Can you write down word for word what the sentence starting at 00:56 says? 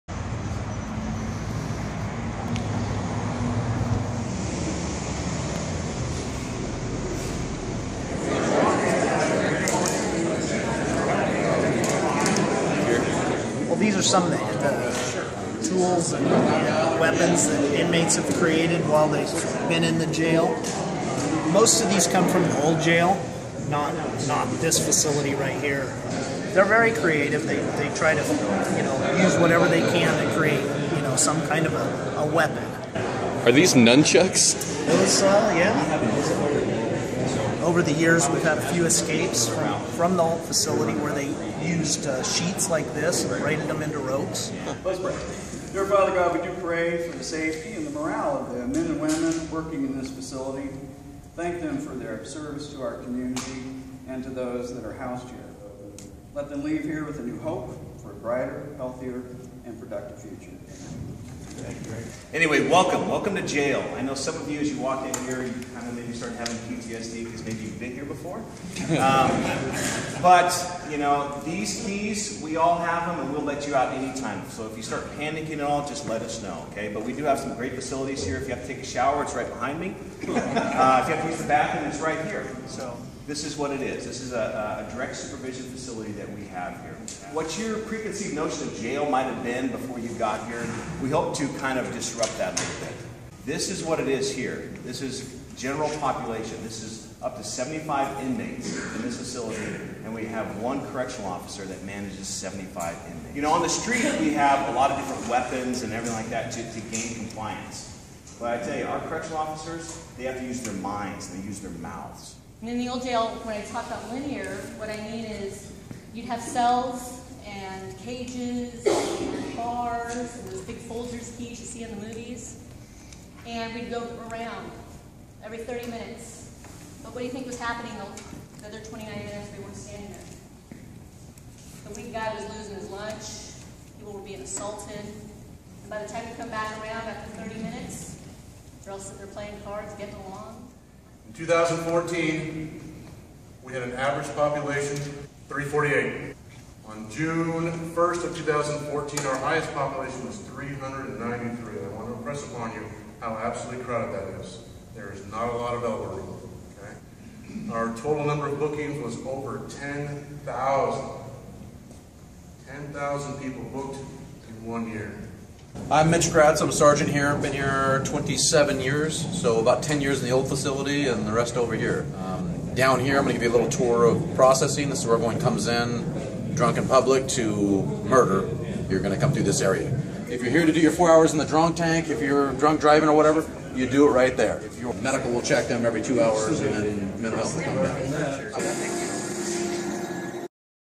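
Let them leave here with a new hope for a brighter, healthier, and productive future.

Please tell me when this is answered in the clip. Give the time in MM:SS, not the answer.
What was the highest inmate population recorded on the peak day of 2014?
02:30.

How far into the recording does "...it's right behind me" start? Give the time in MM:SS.
01:19.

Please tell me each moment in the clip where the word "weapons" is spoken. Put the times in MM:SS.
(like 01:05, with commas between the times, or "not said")
00:16, 00:32, 01:45.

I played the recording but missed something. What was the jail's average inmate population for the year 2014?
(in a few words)
348.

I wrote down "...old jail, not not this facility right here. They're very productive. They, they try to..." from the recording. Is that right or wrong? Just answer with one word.
wrong.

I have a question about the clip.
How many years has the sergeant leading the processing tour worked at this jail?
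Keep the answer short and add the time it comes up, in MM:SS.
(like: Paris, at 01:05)
27 years, at 02:48.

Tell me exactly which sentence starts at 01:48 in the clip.
But I tell you, our correctional officers, they have to use their minds and they use their mouths.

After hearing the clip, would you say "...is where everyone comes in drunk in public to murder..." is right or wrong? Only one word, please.
right.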